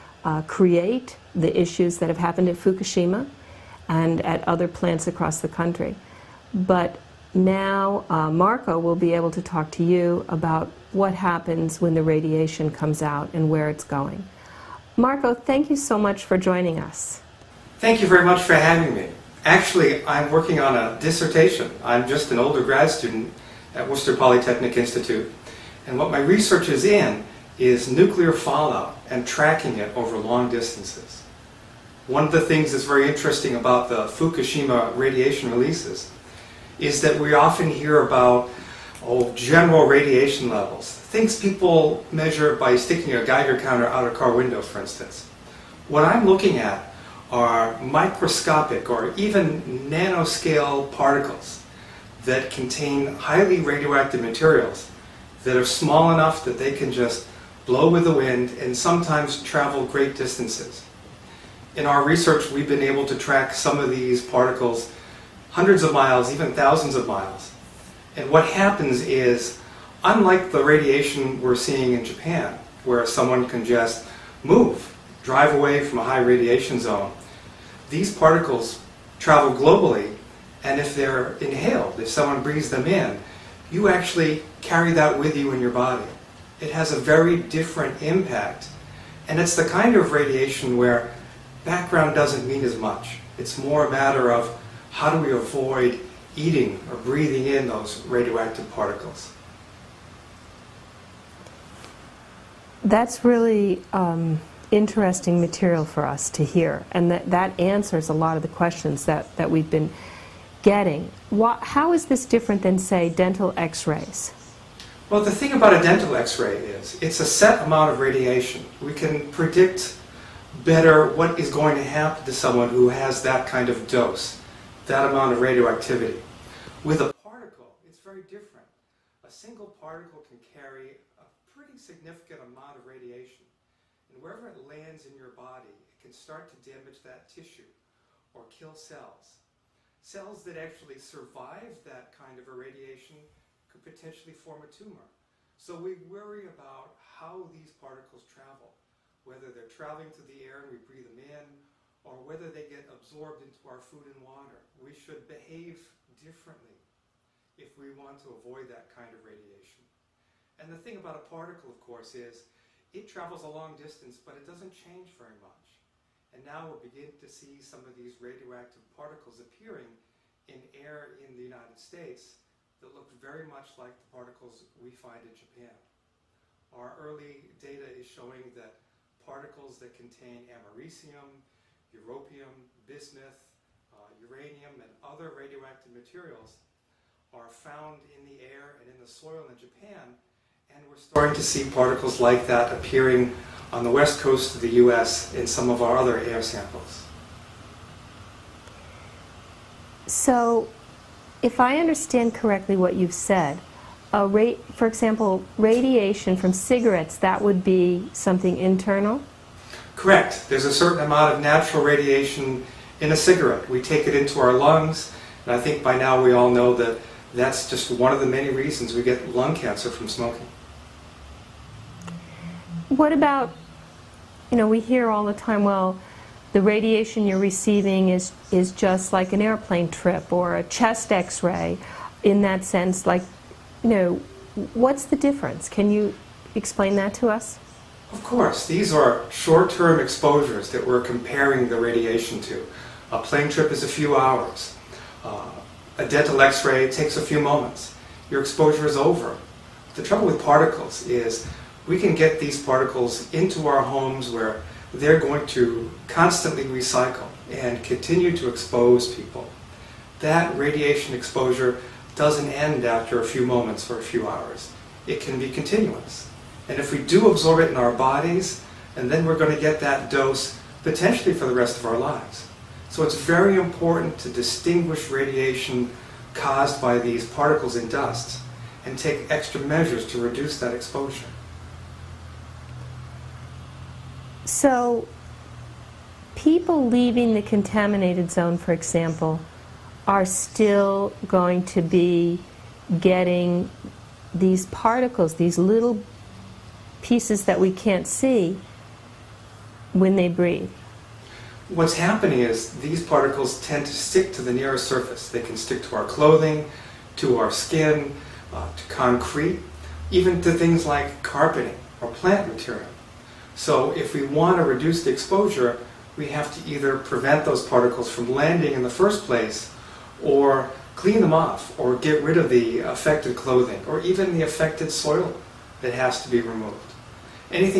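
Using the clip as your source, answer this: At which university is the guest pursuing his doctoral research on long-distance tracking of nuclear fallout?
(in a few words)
Worcester Polytechnic Institute.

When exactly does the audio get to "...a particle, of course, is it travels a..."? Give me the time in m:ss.
2:41.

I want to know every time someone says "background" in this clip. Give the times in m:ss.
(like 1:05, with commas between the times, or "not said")
1:31.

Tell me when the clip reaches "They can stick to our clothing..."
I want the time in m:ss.
5:05.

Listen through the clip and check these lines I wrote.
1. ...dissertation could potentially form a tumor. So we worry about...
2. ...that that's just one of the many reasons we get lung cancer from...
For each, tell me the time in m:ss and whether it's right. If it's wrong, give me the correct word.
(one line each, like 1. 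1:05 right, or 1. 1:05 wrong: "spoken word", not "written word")
1. 2:22 wrong: "irradiation", not "dissertation"
2. 3:36 right.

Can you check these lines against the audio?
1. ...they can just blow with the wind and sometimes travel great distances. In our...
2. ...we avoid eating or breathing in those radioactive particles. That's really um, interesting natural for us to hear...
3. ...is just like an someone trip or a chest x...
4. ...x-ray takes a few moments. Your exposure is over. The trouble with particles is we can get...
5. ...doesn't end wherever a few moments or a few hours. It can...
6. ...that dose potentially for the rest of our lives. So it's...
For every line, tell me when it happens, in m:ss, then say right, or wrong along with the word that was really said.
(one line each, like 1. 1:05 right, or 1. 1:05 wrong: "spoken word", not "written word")
1. 0:56 right
2. 1:35 wrong: "material", not "natural"
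3. 3:48 wrong: "airplane", not "someone"
4. 4:06 right
5. 4:22 wrong: "after", not "wherever"
6. 4:29 right.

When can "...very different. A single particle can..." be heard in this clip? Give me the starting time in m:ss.
2:08.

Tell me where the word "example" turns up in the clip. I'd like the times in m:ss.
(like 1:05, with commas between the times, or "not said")
3:24, 4:48.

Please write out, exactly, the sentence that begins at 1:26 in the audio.
It has a very different impact.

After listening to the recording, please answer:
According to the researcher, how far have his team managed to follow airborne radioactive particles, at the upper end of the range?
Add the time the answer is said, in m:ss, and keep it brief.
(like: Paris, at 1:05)
thousands of miles, at 1:06.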